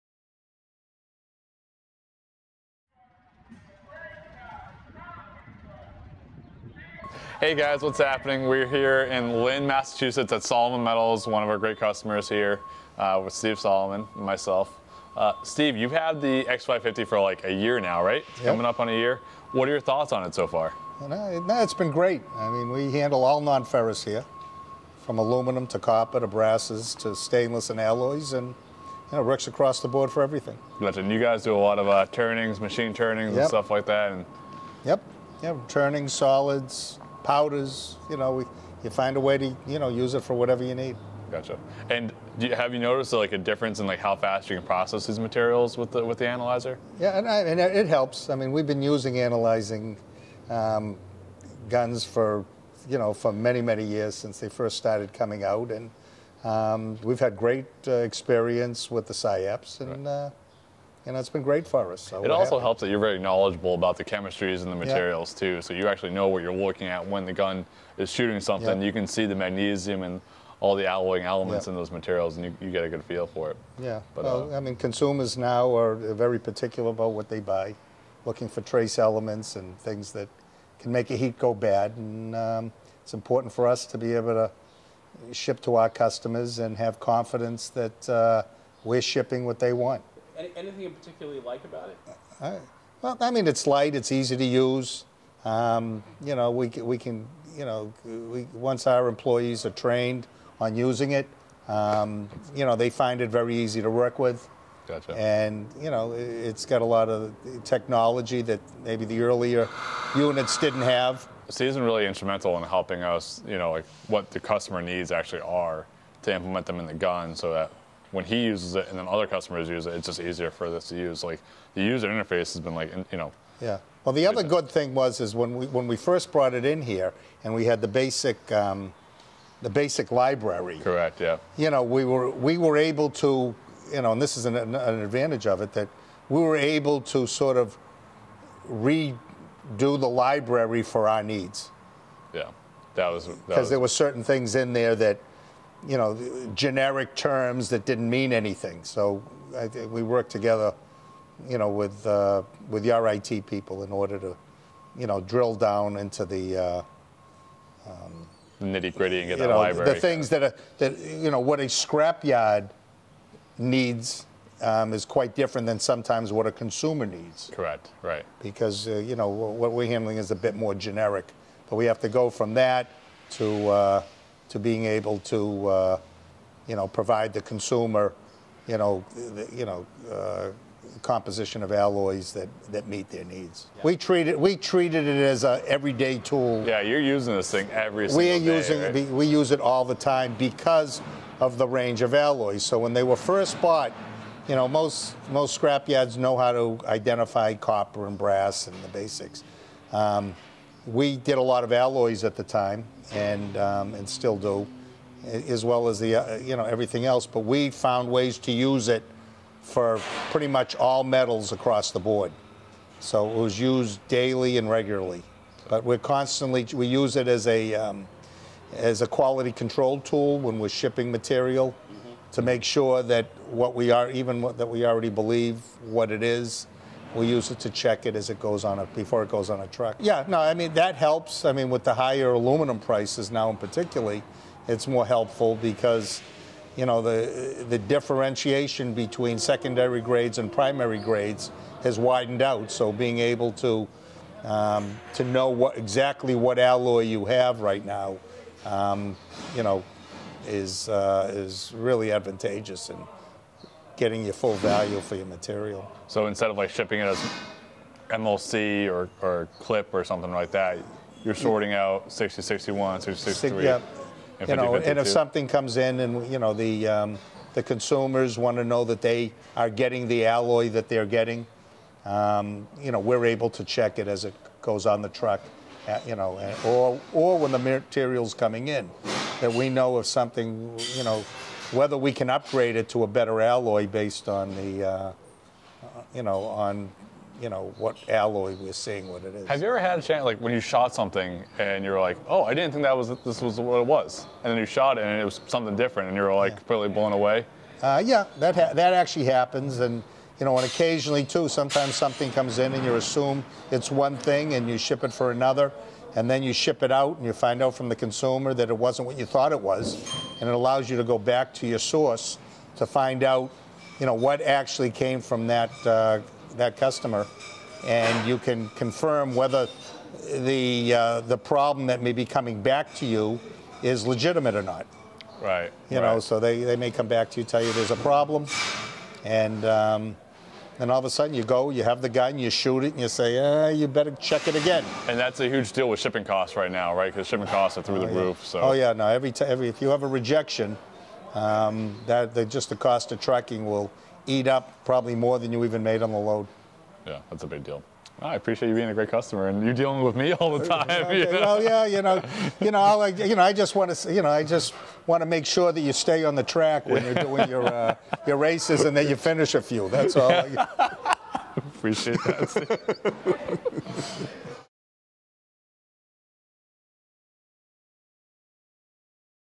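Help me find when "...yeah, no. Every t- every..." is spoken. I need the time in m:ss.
5:38.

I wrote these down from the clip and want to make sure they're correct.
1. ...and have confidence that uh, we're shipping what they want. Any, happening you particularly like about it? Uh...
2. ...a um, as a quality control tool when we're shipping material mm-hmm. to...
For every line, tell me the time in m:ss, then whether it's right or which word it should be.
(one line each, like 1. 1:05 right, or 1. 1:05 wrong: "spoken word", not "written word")
1. 1:26 wrong: "anything", not "happening"
2. 3:37 right.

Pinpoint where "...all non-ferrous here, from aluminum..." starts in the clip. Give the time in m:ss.
0:23.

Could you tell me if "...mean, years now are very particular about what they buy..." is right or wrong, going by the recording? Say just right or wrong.
wrong.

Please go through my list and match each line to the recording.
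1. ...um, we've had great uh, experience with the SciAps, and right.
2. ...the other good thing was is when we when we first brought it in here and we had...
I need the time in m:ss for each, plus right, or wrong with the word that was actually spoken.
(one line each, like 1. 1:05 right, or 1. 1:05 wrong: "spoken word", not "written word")
1. 0:56 right
2. 2:04 right.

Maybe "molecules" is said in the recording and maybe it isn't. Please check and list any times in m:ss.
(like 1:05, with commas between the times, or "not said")
not said.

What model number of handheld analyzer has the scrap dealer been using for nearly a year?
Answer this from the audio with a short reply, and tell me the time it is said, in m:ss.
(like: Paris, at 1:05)
X550, at 0:16.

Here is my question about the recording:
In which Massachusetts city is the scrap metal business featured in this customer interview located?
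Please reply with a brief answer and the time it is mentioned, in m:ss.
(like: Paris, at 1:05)
Lynn, at 0:09.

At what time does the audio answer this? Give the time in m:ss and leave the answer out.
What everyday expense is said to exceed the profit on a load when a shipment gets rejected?
5:43.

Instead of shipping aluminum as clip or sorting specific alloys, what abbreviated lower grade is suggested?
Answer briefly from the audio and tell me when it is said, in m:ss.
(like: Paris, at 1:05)
MLC, at 4:18.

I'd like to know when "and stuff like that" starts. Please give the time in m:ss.
0:33.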